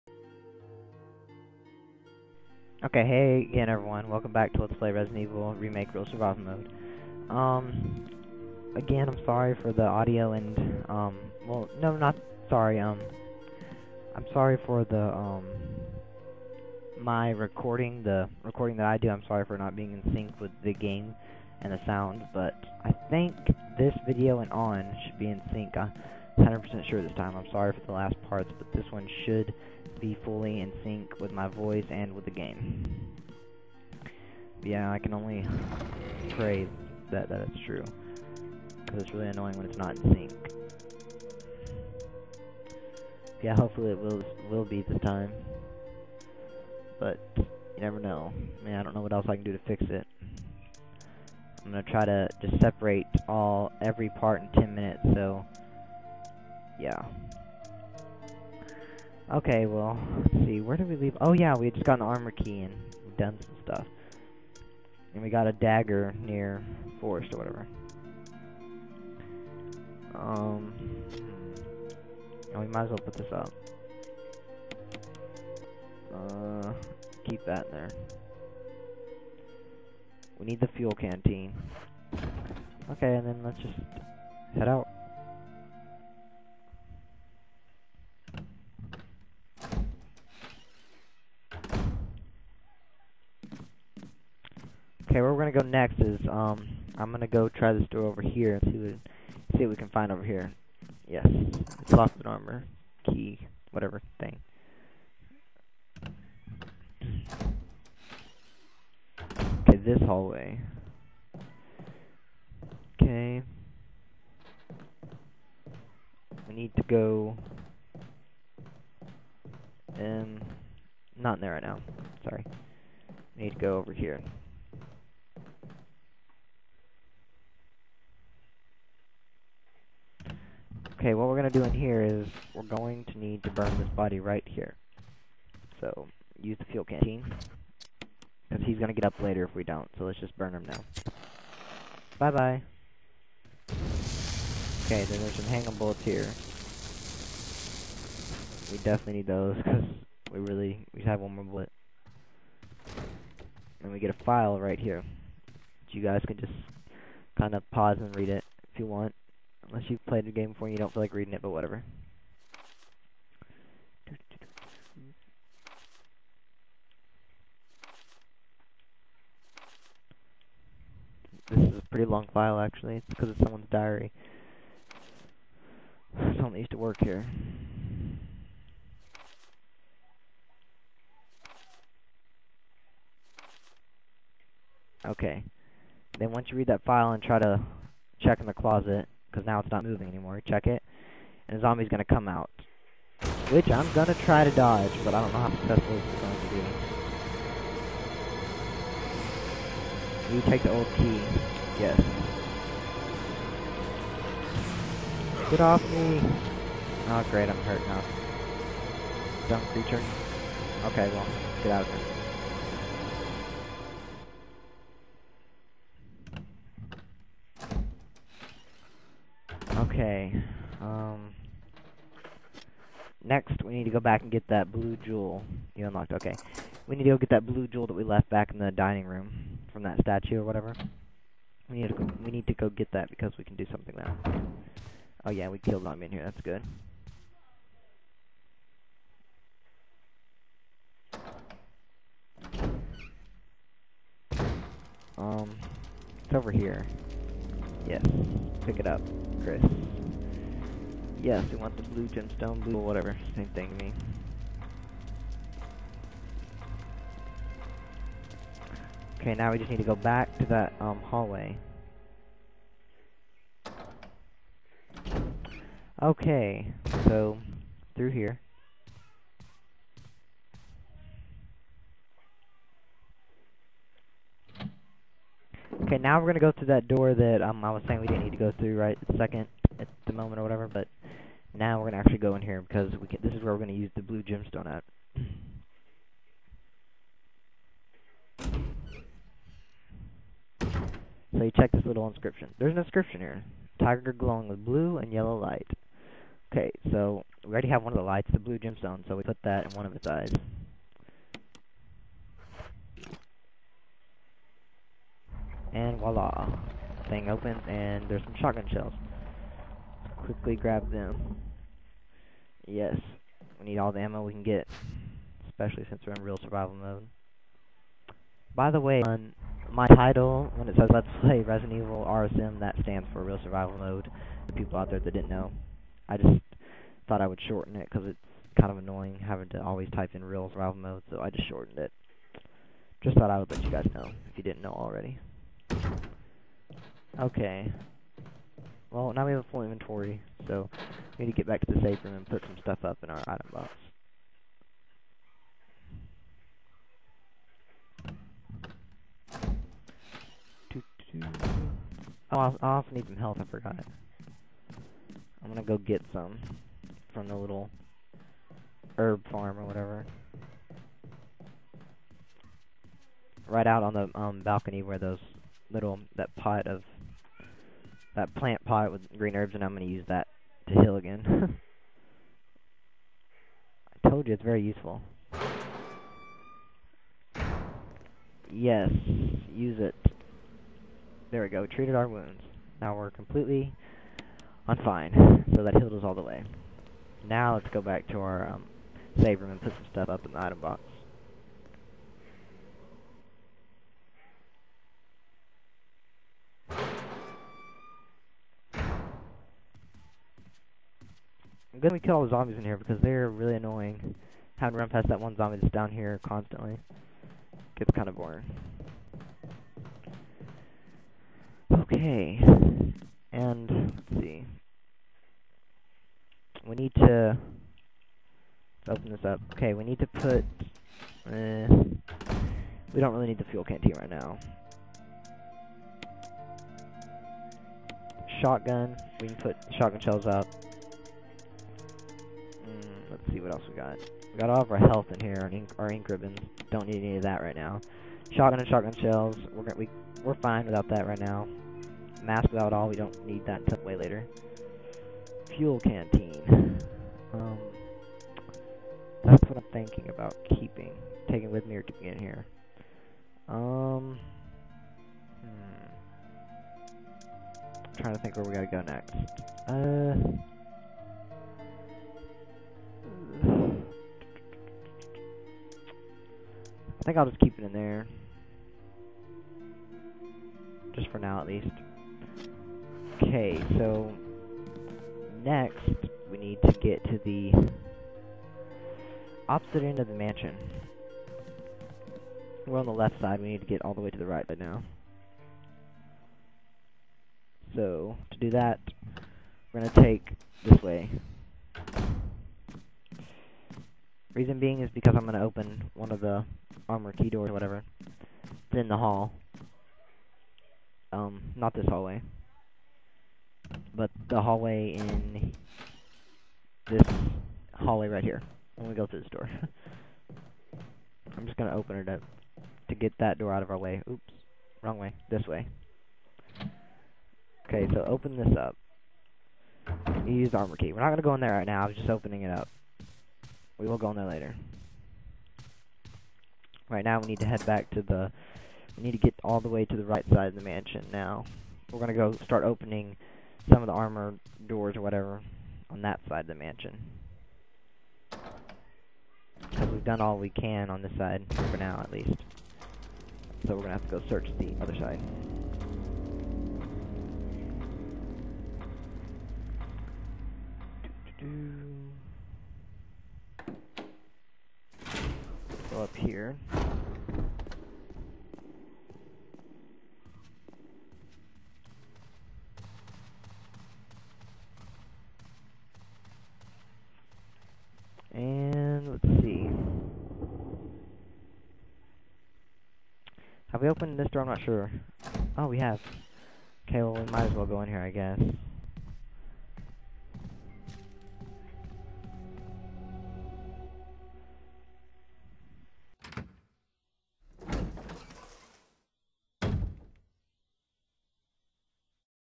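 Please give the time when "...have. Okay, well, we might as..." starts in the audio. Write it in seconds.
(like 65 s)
575 s.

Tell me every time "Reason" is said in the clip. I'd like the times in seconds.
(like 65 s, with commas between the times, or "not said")
494 s.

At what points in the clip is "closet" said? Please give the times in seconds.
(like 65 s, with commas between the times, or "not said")
188 s.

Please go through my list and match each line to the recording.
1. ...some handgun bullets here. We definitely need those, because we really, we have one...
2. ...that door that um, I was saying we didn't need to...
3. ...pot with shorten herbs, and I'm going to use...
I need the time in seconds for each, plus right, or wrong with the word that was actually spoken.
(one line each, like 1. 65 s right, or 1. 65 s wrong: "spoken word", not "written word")
1. 145 s right
2. 276 s right
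3. 368 s wrong: "green", not "shorten".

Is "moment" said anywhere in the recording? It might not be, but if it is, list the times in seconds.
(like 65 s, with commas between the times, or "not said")
280 s.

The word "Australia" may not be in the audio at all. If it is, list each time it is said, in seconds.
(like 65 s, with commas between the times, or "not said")
not said.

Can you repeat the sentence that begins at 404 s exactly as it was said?
Having to run past that one zombie that's down here constantly gets kind of boring.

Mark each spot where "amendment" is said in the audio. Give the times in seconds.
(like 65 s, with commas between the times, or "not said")
not said.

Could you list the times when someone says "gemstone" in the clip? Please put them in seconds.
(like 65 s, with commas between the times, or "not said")
252 s, 284 s, 298 s.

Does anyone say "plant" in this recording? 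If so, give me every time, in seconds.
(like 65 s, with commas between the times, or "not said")
368 s.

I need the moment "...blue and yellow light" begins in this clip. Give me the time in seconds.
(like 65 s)
294 s.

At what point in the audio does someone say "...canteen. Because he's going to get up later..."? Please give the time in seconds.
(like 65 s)
136 s.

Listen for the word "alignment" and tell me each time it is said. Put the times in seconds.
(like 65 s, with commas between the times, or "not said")
not said.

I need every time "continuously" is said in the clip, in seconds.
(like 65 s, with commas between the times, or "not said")
not said.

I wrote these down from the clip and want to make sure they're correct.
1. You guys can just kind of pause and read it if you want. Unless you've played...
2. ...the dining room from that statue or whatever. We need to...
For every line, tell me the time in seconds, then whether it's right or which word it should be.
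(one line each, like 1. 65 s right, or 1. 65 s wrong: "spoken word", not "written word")
1. 155 s right
2. 228 s right.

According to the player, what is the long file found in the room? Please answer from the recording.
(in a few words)
someone's diary.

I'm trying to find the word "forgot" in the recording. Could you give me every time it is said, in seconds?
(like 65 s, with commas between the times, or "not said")
353 s.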